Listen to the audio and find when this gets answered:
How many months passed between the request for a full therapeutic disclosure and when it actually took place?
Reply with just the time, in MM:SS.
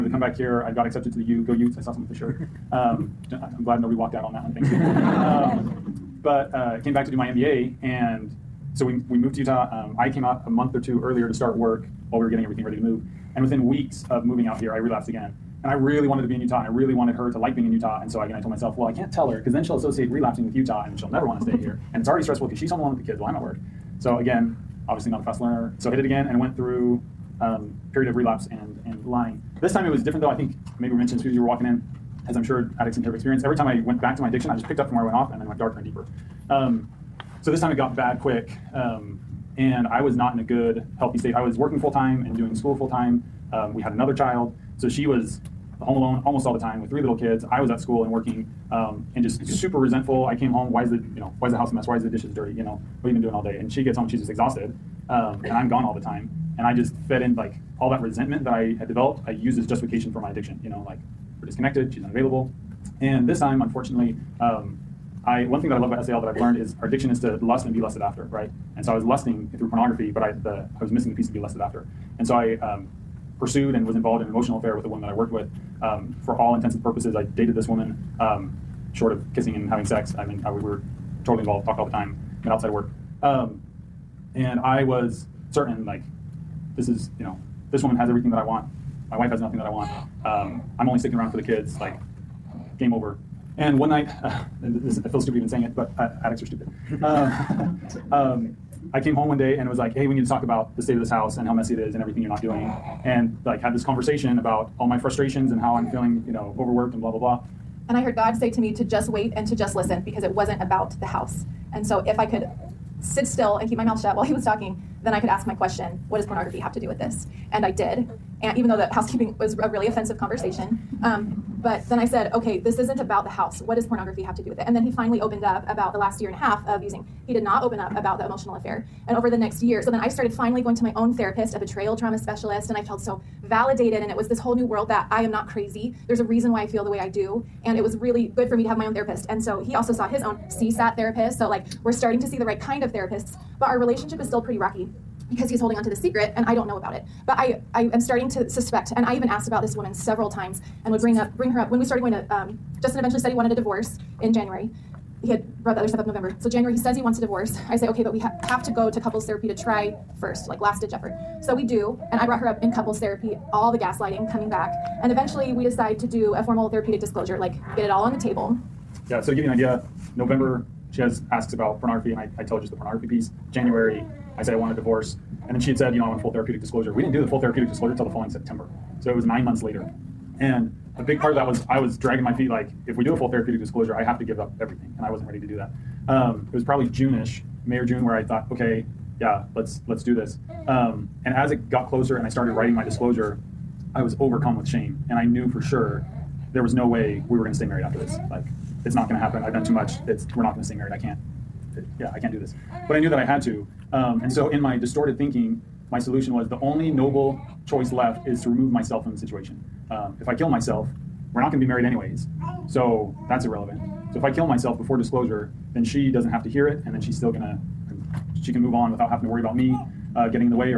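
02:59.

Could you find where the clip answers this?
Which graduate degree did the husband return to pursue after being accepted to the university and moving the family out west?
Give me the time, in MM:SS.
00:07.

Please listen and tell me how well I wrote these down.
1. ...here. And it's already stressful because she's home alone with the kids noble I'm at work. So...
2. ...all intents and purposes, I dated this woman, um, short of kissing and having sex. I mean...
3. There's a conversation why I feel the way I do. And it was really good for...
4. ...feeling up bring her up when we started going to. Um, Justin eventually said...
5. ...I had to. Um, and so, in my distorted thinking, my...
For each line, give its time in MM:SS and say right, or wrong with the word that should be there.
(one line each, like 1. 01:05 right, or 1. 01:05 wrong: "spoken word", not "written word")
1. 00:21 wrong: "while", not "noble"
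2. 01:16 right
3. 02:16 wrong: "reason", not "conversation"
4. 02:31 wrong: "bring", not "feeling"
5. 03:23 right.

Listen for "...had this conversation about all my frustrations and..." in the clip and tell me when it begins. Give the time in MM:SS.
01:43.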